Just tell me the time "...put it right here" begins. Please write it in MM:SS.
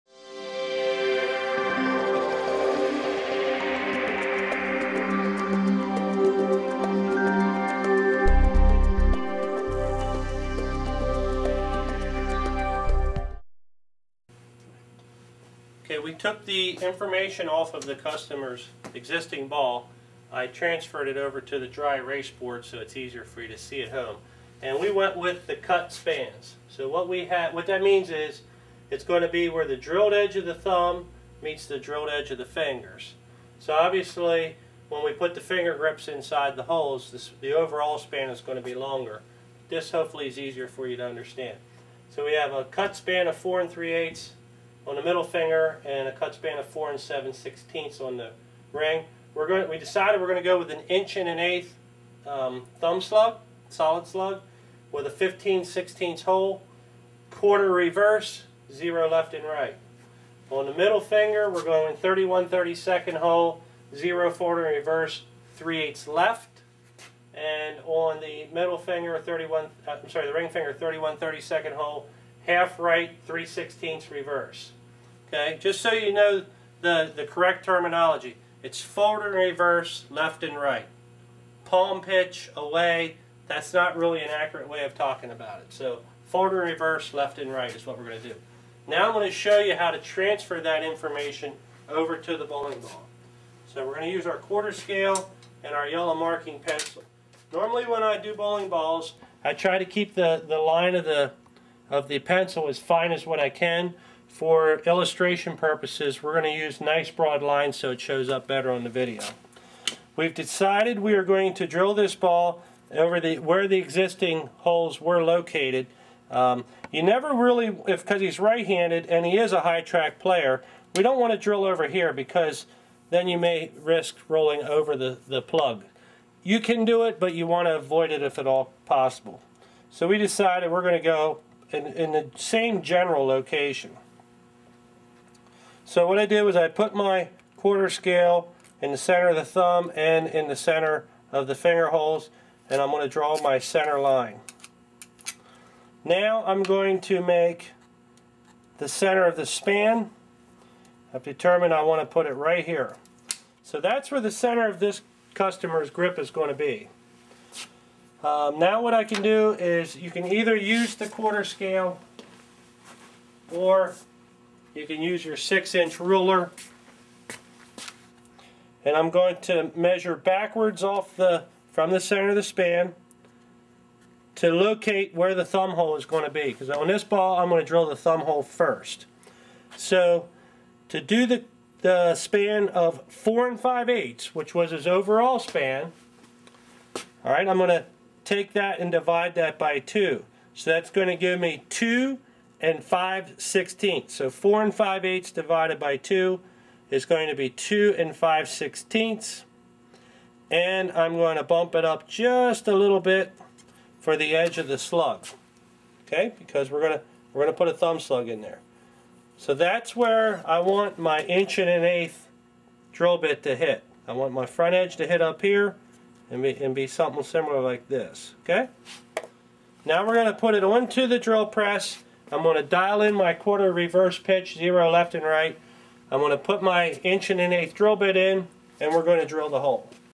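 02:32.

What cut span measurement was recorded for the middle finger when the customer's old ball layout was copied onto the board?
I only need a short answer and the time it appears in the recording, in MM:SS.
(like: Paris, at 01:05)
4 3/8, at 00:43.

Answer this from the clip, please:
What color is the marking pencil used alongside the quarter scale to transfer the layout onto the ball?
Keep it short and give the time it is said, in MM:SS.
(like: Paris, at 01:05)
yellow, at 01:35.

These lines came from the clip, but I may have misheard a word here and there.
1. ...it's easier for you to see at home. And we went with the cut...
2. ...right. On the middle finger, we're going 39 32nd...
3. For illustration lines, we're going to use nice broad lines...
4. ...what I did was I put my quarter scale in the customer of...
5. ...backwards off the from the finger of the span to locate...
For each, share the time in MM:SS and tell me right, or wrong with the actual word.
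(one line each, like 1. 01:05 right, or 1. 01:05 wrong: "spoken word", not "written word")
1. 00:22 right
2. 00:59 wrong: "31", not "39"
3. 01:44 wrong: "purposes", not "lines"
4. 02:16 wrong: "center", not "customer"
5. 02:50 wrong: "center", not "finger".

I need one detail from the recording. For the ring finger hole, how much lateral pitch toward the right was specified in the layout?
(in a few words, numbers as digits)
half right.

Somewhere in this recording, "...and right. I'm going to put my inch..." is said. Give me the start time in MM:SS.
03:45.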